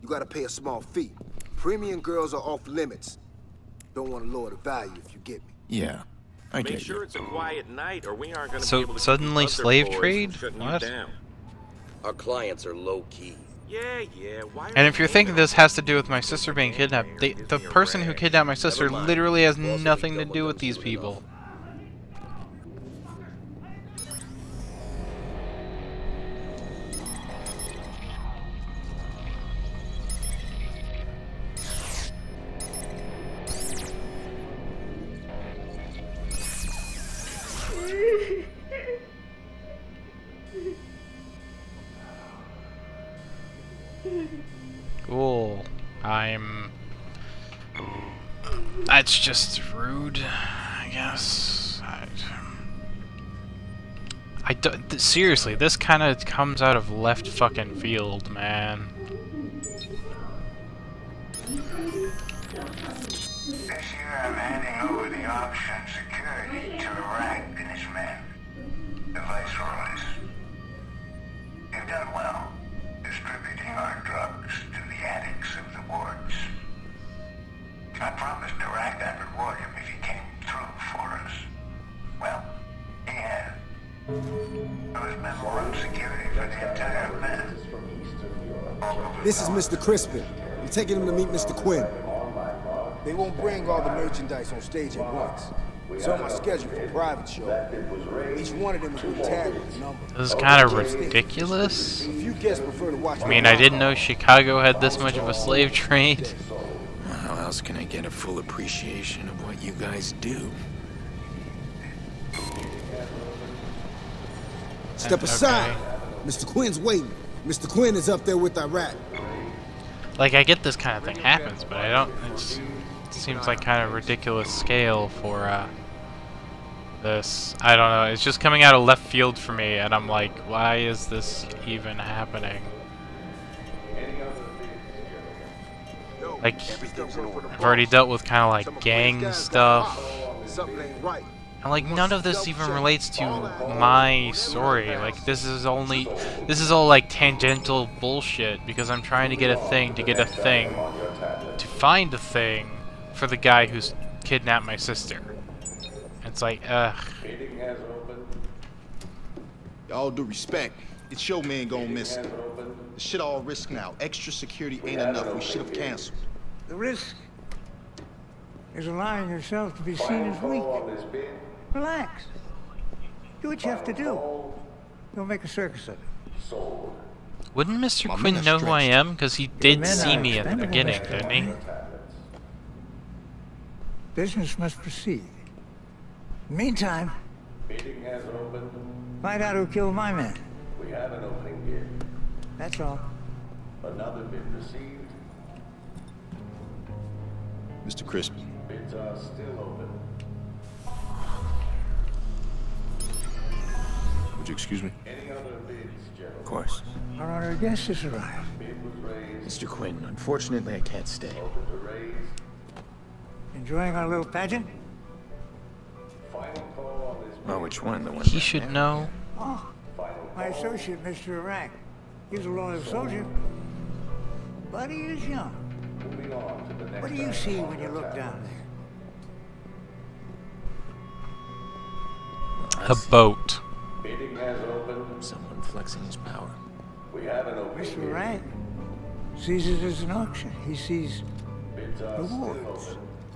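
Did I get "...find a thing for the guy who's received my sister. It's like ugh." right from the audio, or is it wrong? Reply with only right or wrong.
wrong.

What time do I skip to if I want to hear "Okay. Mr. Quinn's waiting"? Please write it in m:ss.
1:55.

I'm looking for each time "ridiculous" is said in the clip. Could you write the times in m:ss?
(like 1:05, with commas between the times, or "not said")
1:40, 2:03.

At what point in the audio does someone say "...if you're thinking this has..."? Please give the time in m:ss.
0:14.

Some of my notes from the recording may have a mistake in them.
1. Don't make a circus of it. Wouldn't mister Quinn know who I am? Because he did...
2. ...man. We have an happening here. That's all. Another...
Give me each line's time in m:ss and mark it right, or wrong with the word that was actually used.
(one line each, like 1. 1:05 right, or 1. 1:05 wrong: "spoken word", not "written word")
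1. 2:55 right
2. 3:10 wrong: "opening", not "happening".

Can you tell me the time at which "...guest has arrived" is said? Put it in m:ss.
3:27.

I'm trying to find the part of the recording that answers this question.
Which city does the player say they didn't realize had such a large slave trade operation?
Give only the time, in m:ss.
1:43.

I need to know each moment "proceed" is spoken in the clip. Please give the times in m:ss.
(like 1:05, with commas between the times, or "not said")
3:04.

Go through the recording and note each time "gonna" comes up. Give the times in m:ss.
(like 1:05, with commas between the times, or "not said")
0:08, 2:41.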